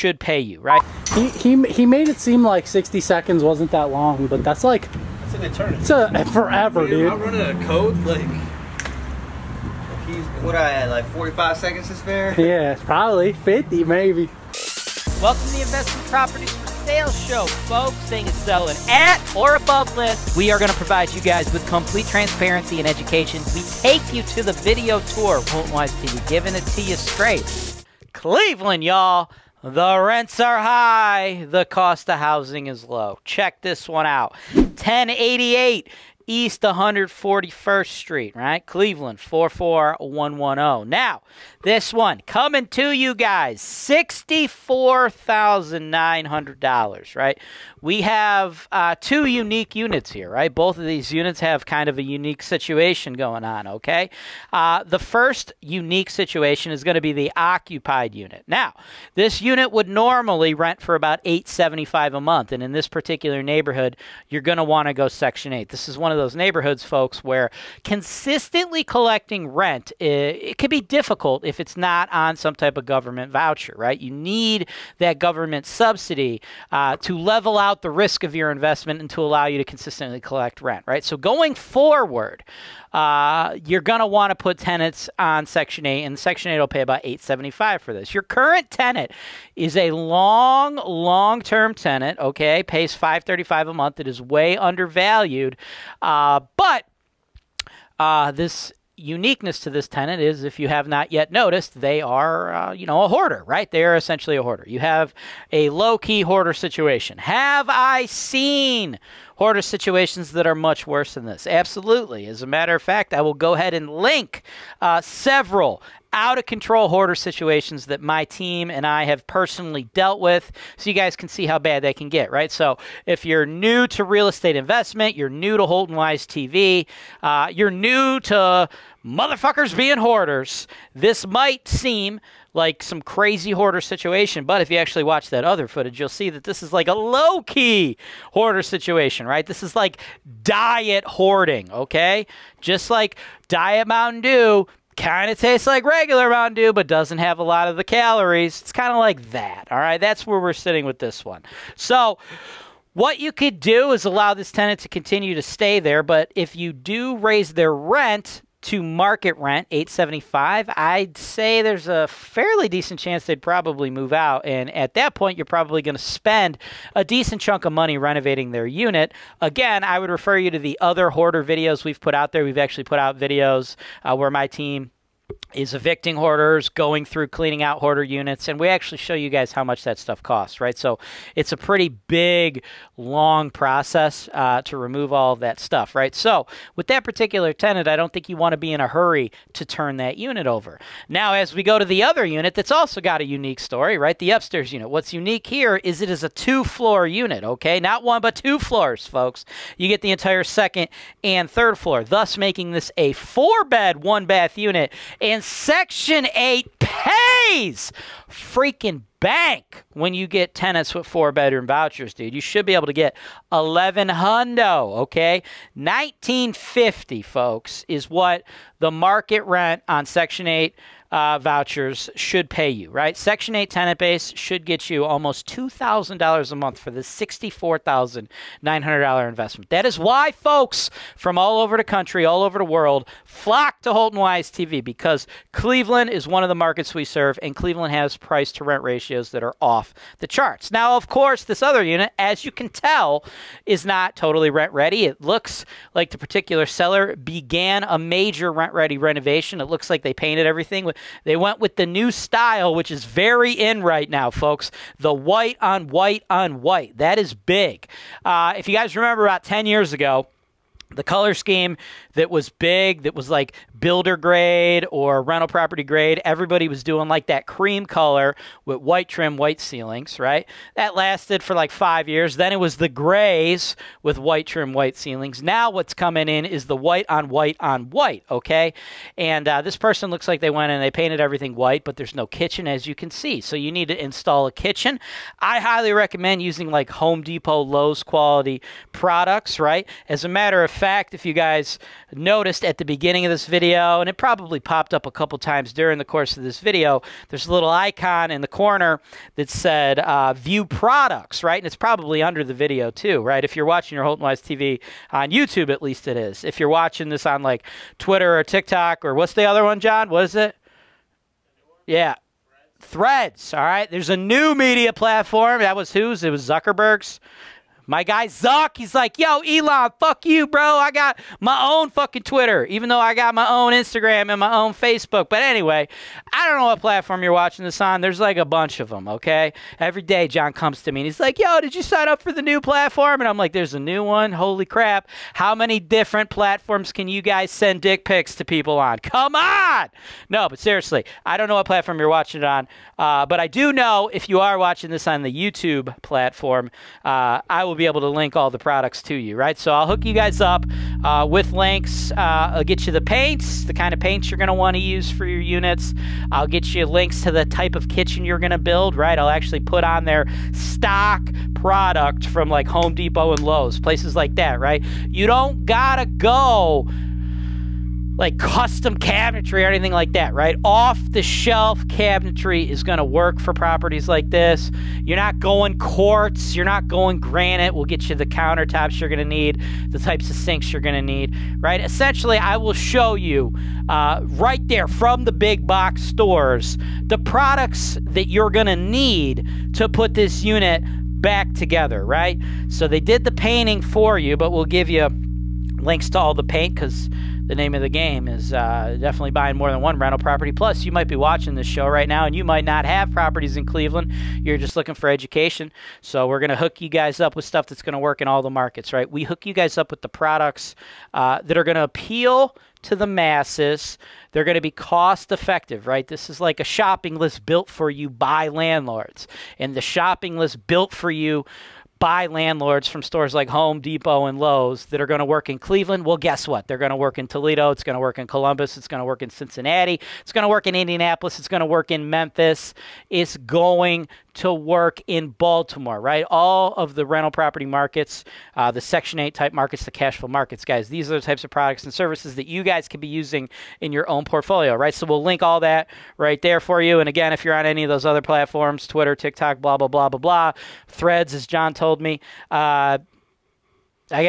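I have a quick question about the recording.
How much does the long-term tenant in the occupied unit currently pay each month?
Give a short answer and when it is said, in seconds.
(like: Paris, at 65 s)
535, at 92 s.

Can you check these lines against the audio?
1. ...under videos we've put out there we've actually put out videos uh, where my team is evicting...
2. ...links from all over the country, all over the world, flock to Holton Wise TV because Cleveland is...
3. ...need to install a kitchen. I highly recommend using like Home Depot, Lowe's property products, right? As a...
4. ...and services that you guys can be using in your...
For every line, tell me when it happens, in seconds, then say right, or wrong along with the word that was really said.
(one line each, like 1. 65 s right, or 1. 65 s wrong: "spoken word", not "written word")
1. 171 s wrong: "hoarder", not "under"
2. 230 s wrong: "folks", not "links"
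3. 283 s wrong: "quality", not "property"
4. 441 s right.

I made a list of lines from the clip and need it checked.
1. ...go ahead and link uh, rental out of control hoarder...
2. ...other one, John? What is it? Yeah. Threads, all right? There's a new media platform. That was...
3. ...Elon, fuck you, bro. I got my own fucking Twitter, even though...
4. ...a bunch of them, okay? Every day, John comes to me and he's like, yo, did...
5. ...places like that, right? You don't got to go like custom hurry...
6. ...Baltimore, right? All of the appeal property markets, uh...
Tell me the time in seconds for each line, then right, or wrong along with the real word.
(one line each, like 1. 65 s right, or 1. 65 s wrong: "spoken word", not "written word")
1. 113 s wrong: "several", not "rental"
2. 309 s right
3. 319 s right
4. 328 s right
5. 363 s wrong: "cabinetry", not "hurry"
6. 435 s wrong: "rental", not "appeal".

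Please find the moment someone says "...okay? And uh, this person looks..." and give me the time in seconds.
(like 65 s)
278 s.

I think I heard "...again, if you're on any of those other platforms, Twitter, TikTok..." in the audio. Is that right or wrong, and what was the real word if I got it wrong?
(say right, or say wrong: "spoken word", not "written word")
right.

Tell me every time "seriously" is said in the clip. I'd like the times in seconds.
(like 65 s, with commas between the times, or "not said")
340 s.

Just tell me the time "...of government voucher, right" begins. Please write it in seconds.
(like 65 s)
72 s.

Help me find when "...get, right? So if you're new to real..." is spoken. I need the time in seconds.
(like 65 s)
122 s.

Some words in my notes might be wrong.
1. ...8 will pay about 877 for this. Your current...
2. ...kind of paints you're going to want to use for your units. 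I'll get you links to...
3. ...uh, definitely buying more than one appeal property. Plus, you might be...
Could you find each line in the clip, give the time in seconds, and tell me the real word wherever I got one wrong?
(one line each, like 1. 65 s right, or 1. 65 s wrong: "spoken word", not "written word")
1. 86 s wrong: "875", not "877"
2. 353 s right
3. 398 s wrong: "rental", not "appeal".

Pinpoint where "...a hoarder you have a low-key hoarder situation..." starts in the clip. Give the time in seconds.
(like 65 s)
104 s.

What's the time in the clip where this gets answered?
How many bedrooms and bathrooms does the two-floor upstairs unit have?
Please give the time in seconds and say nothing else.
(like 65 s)
203 s.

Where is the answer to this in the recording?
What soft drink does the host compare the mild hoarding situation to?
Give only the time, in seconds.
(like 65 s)
143 s.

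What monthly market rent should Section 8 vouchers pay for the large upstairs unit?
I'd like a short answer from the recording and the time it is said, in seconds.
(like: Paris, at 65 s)
1950, at 215 s.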